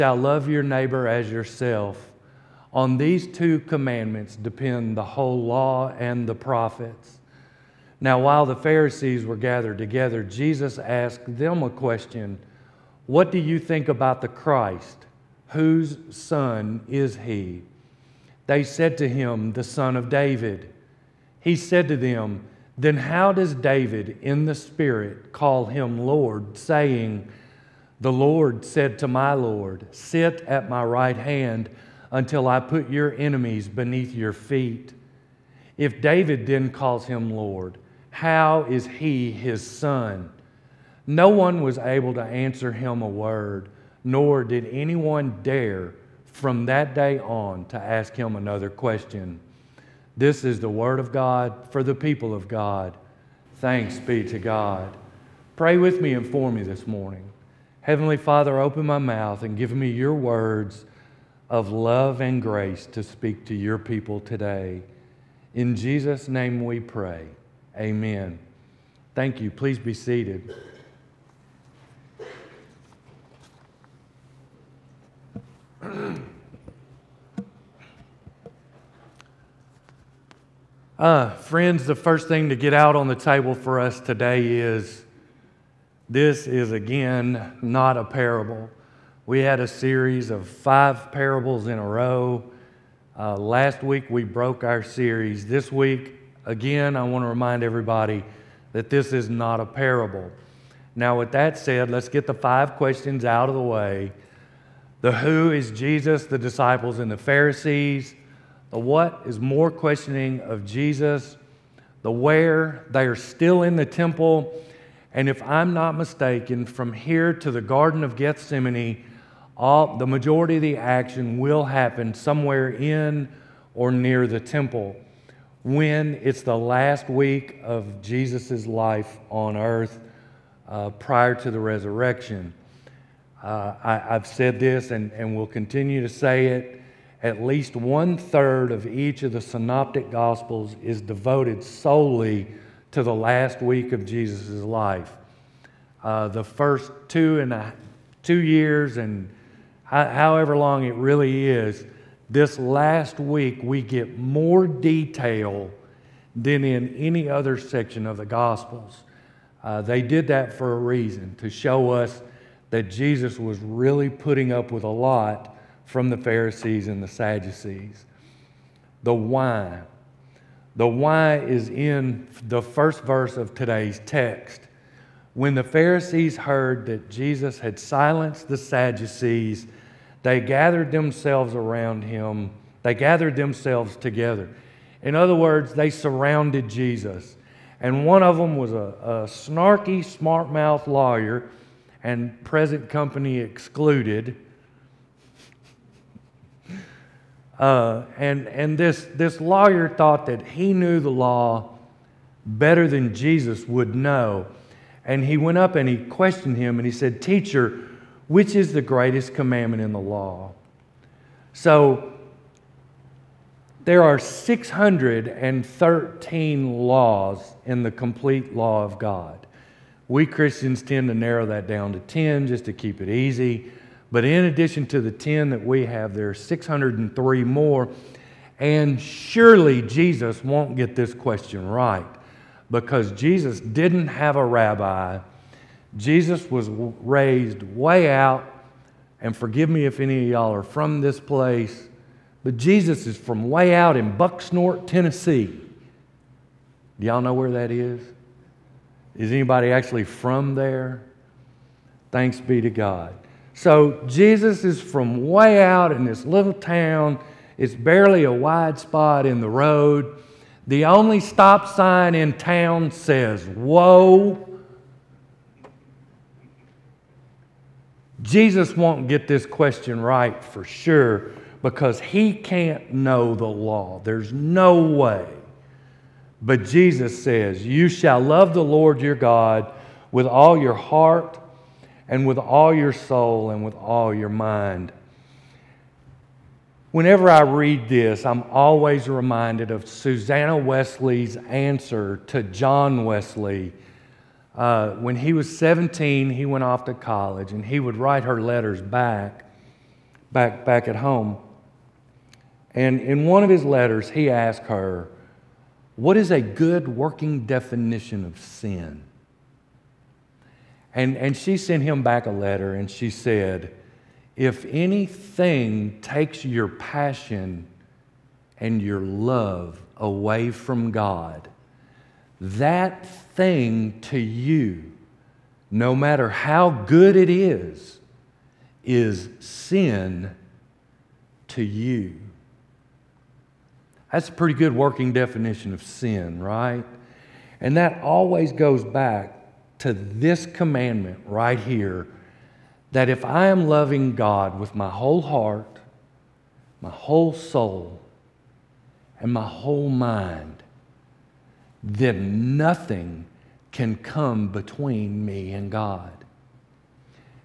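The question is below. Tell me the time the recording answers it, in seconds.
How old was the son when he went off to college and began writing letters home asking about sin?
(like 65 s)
295 s.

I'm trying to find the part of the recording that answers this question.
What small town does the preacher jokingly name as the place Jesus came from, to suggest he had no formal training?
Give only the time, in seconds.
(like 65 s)
244 s.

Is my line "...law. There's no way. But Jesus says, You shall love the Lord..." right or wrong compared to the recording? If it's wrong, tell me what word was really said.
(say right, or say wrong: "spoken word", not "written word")
right.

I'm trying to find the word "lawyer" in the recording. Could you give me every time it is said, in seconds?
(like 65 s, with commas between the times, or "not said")
190 s, 199 s.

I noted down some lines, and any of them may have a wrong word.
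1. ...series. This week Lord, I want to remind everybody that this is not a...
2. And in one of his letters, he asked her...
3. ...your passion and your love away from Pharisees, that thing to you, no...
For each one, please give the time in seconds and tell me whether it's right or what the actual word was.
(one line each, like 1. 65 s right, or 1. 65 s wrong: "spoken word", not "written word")
1. 94 s wrong: "Again", not "Lord"
2. 302 s right
3. 316 s wrong: "God", not "Pharisees".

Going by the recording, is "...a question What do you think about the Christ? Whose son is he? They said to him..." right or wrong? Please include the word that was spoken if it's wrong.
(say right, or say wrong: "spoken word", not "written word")
right.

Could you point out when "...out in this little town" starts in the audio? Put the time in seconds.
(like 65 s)
255 s.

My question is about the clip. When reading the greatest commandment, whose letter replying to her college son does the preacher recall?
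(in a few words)
Susanna Wesley.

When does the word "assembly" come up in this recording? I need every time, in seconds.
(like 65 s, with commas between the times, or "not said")
not said.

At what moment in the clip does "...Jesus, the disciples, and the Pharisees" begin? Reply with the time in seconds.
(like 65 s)
105 s.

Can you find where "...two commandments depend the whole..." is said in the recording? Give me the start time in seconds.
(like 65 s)
3 s.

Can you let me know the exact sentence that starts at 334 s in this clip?
That's a pretty good working definition of sin, right?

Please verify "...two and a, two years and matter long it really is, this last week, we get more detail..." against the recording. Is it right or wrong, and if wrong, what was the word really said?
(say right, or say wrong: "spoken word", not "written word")
wrong: "however", not "matter".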